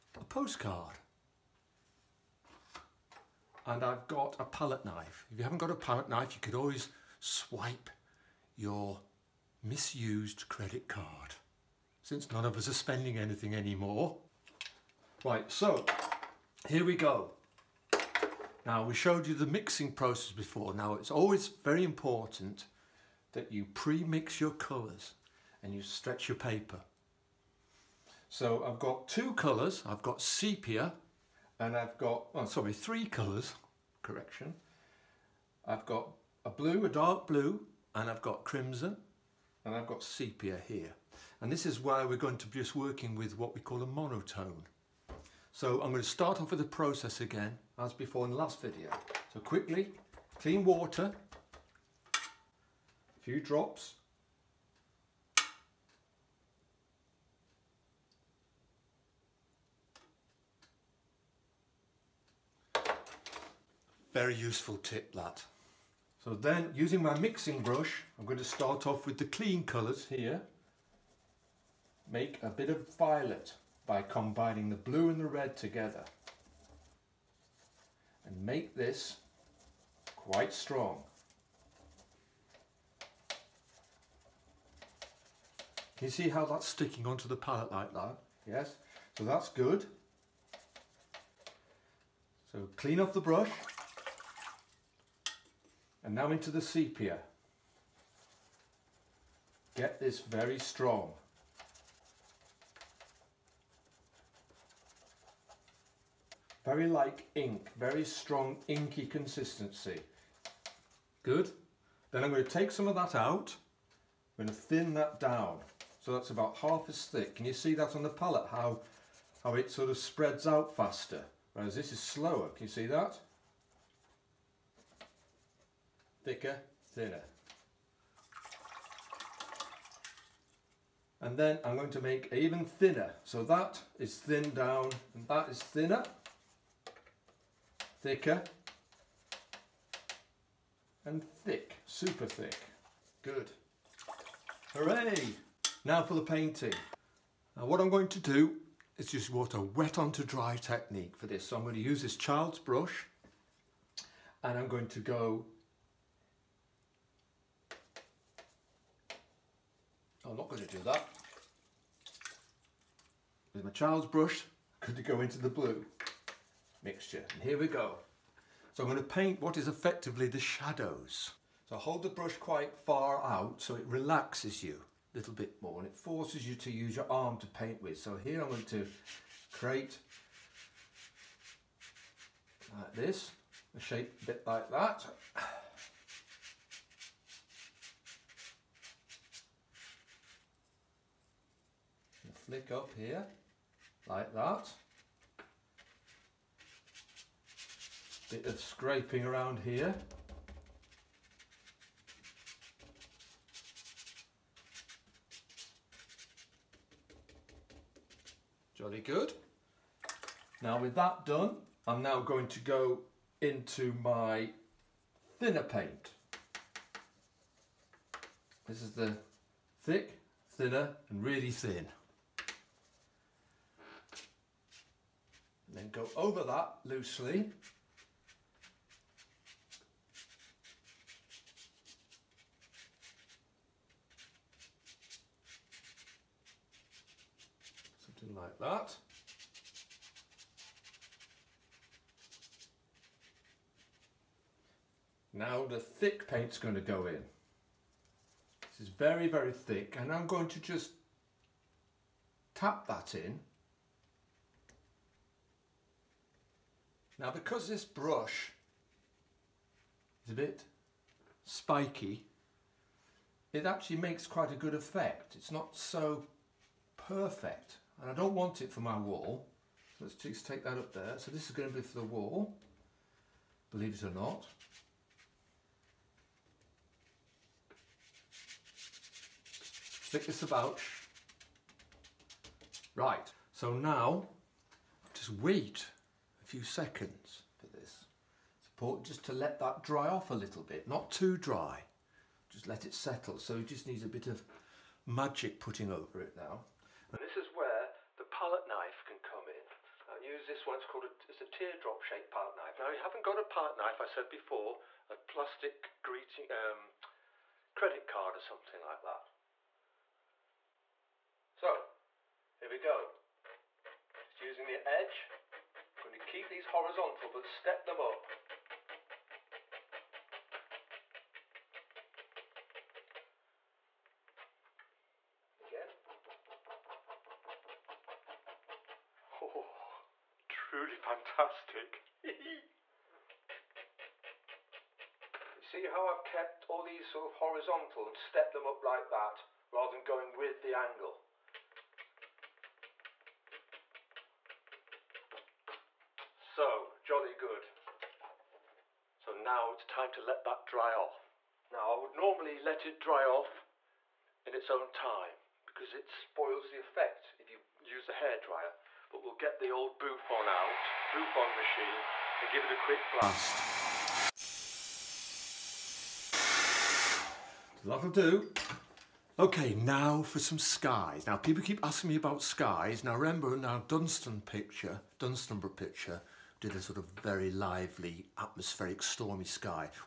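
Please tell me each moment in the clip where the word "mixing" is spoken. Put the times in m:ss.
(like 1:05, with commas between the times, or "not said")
0:19, 1:07.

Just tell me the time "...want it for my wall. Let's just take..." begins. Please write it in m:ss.
4:28.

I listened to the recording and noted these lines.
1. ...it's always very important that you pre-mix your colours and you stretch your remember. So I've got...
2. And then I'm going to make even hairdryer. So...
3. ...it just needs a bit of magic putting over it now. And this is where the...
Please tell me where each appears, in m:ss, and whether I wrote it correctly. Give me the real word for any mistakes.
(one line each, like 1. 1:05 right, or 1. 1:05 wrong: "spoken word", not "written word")
1. 0:20 wrong: "paper", not "remember"
2. 2:11 wrong: "thinner", not "hairdryer"
3. 4:53 right.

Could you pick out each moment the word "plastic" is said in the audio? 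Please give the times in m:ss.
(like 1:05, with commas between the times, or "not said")
5:05.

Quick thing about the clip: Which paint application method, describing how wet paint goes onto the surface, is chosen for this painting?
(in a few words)
wet onto dry.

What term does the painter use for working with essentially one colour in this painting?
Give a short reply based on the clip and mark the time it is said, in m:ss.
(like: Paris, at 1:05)
monotone, at 0:43.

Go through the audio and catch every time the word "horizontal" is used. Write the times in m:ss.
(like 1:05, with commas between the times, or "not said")
5:16, 5:37.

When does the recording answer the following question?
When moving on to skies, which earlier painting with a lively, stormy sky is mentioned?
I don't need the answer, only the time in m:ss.
6:15.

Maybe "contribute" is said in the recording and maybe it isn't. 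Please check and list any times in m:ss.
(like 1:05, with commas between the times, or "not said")
not said.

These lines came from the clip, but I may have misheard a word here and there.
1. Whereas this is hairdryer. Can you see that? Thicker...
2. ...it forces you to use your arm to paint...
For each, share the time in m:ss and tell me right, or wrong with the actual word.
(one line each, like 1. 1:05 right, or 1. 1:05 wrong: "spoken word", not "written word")
1. 2:01 wrong: "slower", not "hairdryer"
2. 2:55 right.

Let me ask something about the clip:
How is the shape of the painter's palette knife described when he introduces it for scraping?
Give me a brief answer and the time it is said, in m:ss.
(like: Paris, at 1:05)
teardrop shaped, at 5:01.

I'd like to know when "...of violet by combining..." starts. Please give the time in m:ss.
1:12.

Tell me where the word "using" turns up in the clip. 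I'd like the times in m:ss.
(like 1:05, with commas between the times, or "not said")
1:06, 5:14.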